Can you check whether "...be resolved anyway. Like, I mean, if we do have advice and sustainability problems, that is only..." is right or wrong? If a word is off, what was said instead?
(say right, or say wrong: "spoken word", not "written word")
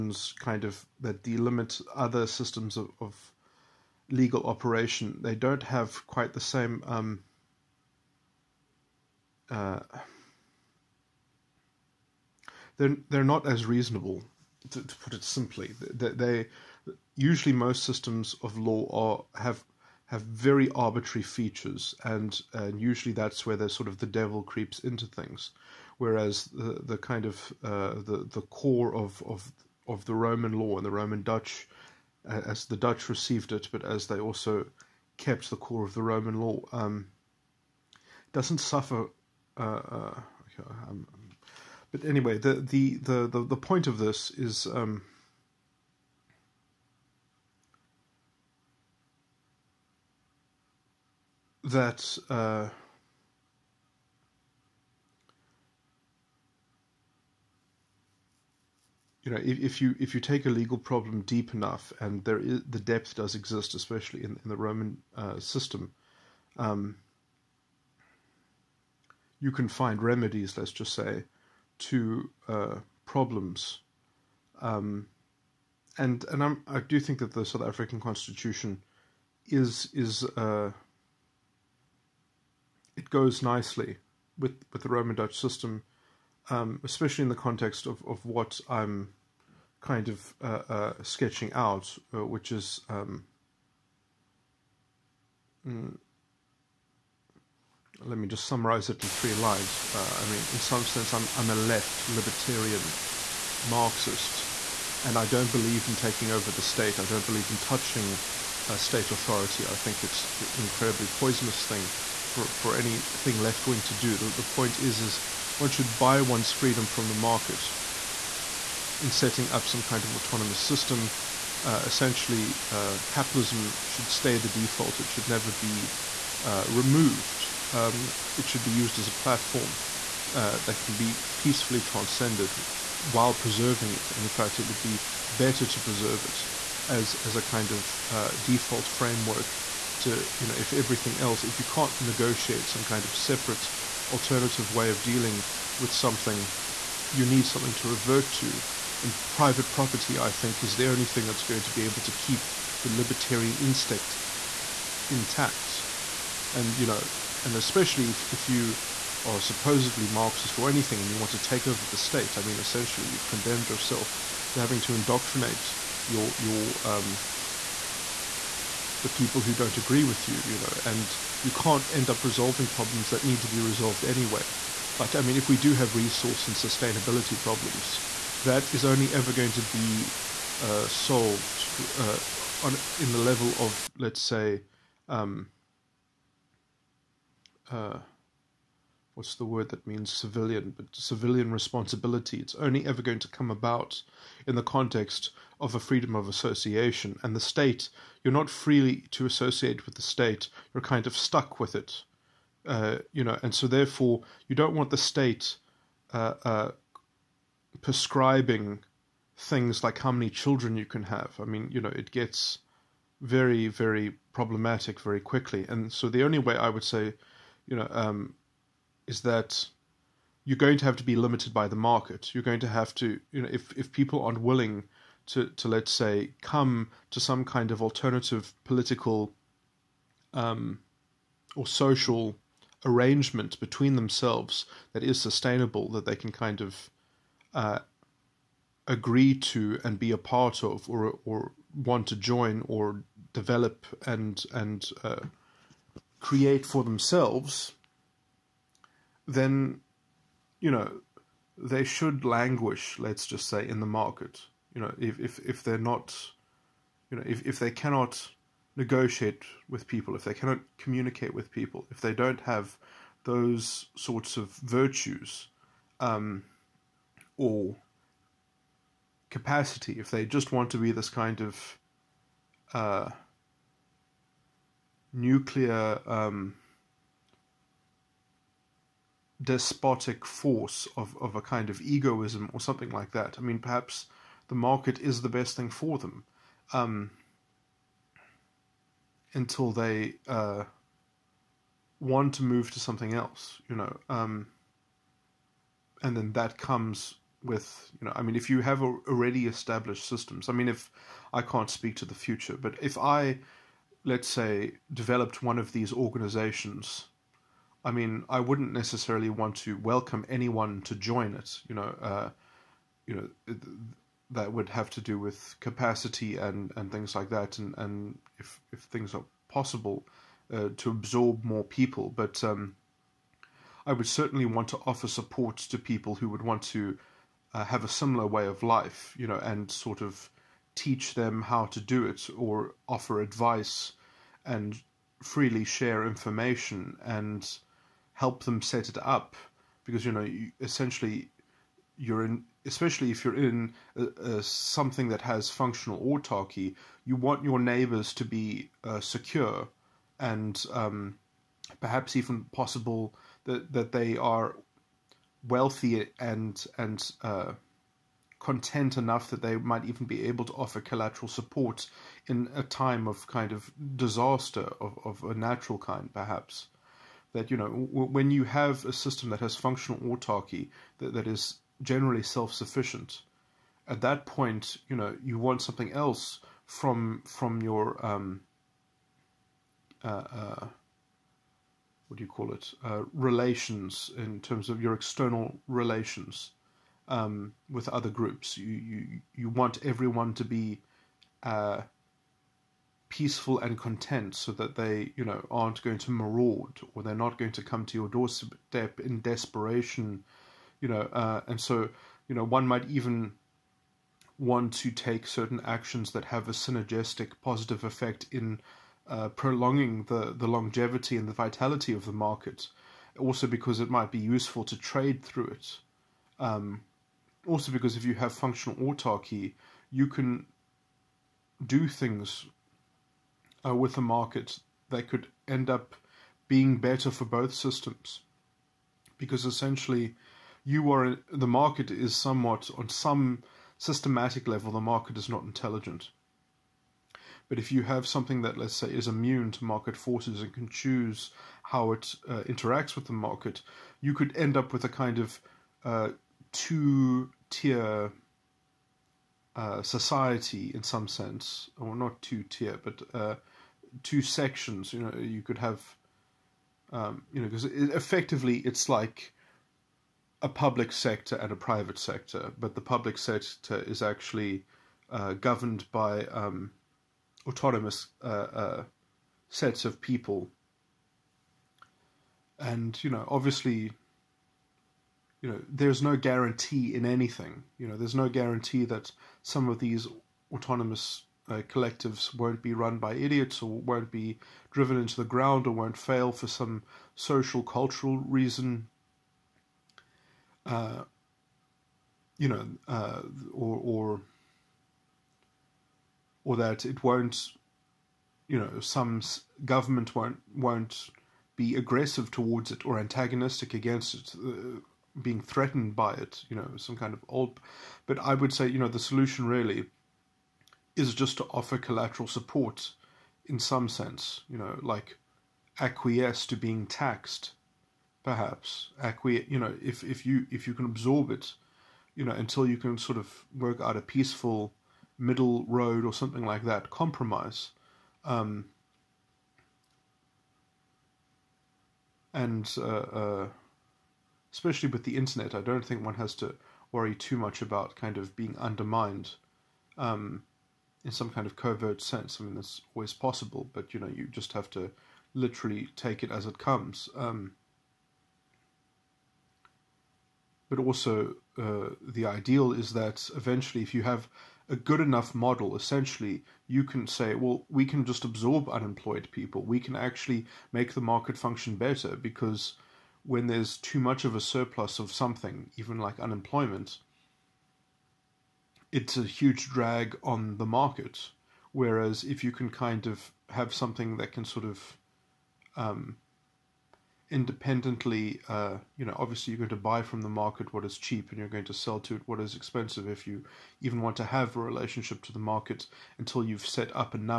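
wrong: "resource", not "advice".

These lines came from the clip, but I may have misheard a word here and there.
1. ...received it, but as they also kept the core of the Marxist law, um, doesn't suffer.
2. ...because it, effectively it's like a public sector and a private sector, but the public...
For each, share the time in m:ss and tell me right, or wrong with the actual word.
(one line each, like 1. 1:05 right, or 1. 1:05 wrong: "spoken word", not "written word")
1. 0:33 wrong: "Roman", not "Marxist"
2. 7:37 right.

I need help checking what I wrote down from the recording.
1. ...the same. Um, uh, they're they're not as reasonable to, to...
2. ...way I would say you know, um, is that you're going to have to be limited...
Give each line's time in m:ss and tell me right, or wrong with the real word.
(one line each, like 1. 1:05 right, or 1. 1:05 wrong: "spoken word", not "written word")
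1. 0:06 right
2. 3:36 right.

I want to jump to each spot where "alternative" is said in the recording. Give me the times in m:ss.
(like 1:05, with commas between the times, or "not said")
2:24, 3:47.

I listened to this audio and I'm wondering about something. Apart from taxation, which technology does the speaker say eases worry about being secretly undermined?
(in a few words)
the internet.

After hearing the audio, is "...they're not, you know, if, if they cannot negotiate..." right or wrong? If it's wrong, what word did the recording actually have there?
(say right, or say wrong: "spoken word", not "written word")
right.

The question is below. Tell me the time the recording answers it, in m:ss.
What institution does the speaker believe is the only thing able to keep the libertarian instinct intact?
2:29.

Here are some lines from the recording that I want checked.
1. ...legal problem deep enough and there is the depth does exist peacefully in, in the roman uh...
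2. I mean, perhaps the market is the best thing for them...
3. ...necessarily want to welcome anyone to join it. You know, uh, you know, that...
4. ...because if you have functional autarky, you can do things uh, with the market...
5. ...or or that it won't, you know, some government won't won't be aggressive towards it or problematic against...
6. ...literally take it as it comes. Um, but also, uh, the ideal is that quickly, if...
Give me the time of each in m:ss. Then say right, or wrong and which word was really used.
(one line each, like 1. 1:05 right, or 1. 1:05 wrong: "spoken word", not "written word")
1. 1:00 wrong: "especially", not "peacefully"
2. 4:43 right
3. 5:08 right
4. 6:57 right
5. 8:13 wrong: "antagonistic", not "problematic"
6. 9:05 wrong: "eventually", not "quickly".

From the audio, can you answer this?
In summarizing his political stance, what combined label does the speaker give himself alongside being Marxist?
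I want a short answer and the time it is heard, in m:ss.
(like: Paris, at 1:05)
left libertarian, at 1:41.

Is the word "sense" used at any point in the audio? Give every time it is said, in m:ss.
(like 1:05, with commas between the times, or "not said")
1:40, 7:31, 8:33, 9:02.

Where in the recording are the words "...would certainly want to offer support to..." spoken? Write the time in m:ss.
5:23.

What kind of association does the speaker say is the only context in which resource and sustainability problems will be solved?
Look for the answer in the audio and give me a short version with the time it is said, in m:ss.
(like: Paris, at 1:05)
freedom of association, at 3:15.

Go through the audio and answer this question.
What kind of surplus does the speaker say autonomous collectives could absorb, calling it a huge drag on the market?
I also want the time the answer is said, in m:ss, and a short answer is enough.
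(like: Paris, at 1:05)
Unemployment, at 9:26.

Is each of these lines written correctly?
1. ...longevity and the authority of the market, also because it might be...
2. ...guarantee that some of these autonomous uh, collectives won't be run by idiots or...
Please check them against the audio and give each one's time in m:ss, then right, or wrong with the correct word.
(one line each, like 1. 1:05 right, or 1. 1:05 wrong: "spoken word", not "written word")
1. 6:50 wrong: "vitality", not "authority"
2. 7:58 right.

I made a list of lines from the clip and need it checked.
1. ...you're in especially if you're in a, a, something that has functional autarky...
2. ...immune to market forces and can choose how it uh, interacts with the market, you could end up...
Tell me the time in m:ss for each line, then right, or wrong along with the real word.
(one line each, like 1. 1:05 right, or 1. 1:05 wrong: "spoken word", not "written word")
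1. 5:41 right
2. 7:19 right.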